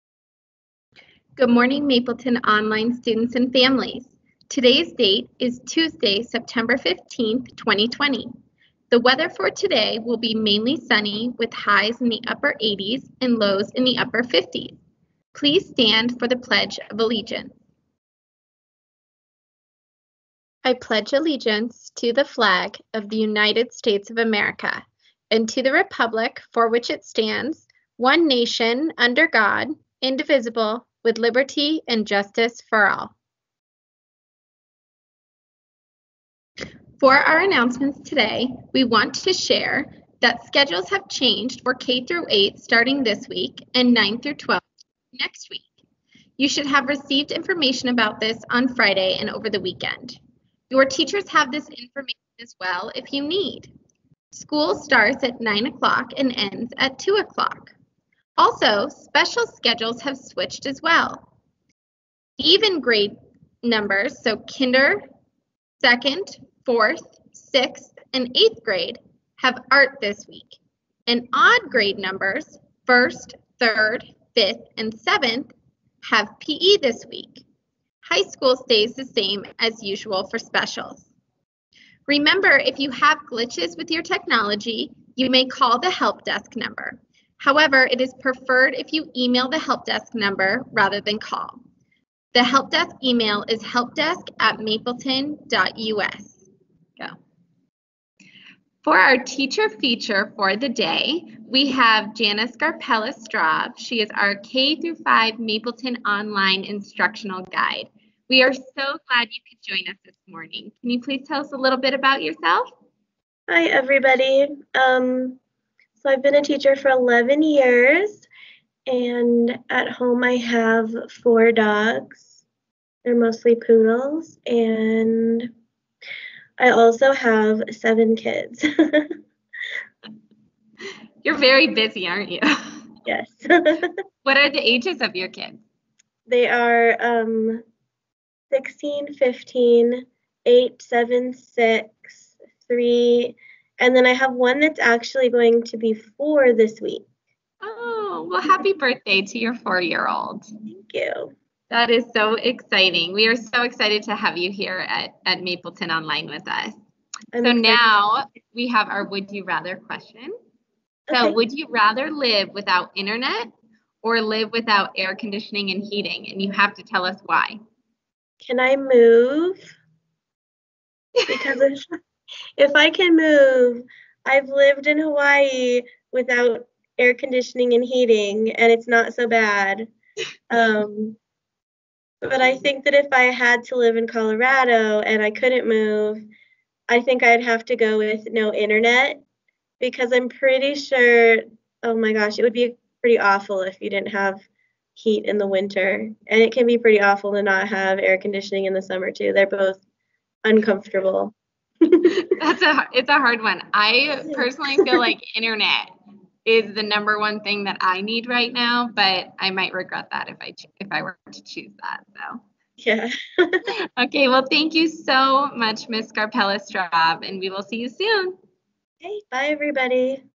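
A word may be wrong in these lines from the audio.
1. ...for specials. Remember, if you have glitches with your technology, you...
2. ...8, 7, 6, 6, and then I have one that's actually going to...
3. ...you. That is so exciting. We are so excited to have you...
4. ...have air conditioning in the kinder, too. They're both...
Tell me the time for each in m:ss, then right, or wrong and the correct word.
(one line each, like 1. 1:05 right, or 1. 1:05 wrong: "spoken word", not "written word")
1. 1:20 right
2. 2:20 wrong: "3", not "6"
3. 2:30 right
4. 3:17 wrong: "summer", not "kinder".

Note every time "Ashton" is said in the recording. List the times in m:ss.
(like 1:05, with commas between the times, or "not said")
not said.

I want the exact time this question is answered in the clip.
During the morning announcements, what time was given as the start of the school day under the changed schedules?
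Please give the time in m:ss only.
0:55.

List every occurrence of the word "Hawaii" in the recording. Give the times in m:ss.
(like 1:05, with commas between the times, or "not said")
2:54.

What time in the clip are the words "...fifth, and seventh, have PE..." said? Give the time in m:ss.
1:14.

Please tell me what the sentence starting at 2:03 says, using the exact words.
They're mostly poodles, and I also have seven kids.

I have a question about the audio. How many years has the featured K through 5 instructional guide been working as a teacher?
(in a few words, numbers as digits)
11.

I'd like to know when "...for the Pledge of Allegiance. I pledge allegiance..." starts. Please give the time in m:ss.
0:16.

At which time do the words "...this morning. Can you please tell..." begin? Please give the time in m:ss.
1:50.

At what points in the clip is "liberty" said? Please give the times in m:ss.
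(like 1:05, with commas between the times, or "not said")
0:31.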